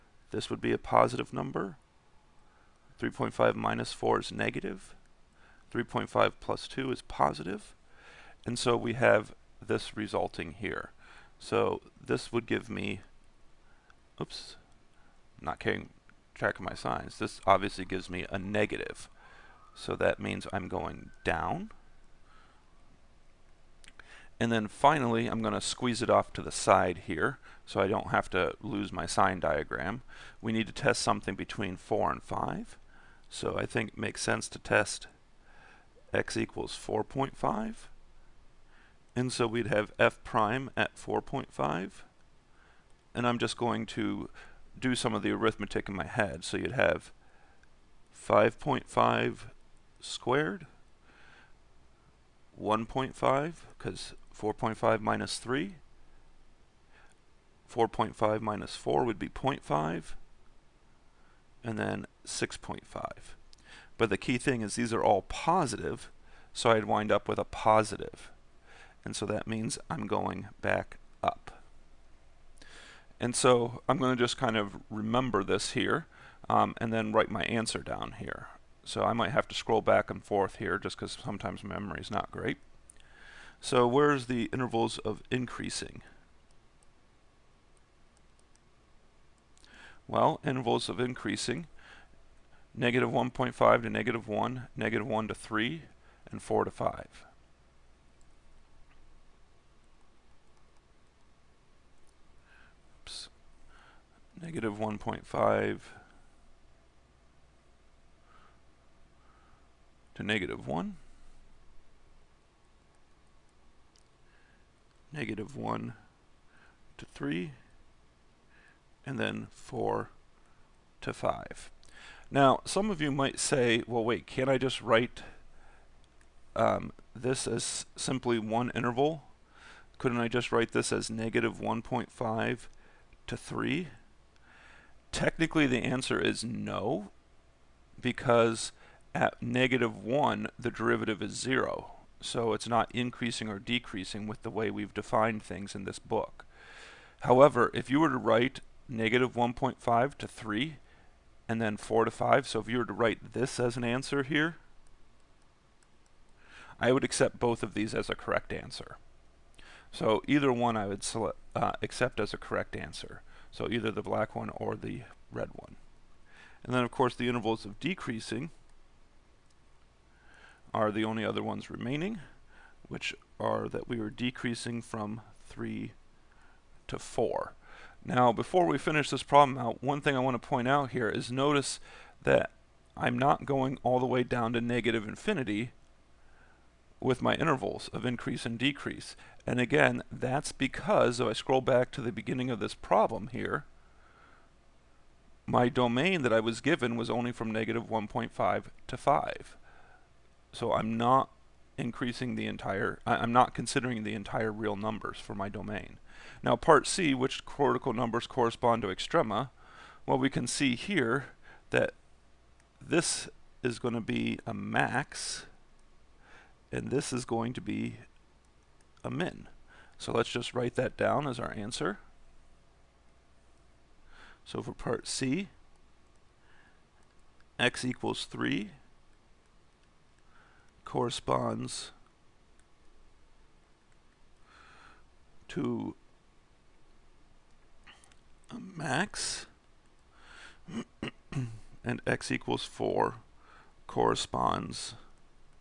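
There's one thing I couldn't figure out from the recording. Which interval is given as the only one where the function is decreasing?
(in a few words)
3 to 4.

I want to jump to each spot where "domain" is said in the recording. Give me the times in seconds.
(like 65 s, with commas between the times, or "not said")
195 s, 205 s.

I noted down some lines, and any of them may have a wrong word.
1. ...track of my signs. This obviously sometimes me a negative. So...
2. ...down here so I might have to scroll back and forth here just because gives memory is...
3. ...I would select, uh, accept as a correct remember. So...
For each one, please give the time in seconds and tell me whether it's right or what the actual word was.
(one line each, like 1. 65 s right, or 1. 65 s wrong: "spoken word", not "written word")
1. 16 s wrong: "gives", not "sometimes"
2. 77 s wrong: "sometimes", not "gives"
3. 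160 s wrong: "answer", not "remember".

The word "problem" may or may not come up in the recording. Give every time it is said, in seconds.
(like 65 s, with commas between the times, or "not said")
179 s, 192 s.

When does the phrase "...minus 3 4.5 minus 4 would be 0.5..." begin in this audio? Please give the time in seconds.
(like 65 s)
55 s.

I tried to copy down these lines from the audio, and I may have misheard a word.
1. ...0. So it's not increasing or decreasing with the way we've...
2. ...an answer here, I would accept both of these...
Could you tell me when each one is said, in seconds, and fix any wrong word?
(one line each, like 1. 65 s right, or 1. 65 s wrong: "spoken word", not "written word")
1. 141 s right
2. 153 s right.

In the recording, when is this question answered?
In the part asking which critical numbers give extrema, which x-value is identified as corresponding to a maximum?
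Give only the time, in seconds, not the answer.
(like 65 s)
227 s.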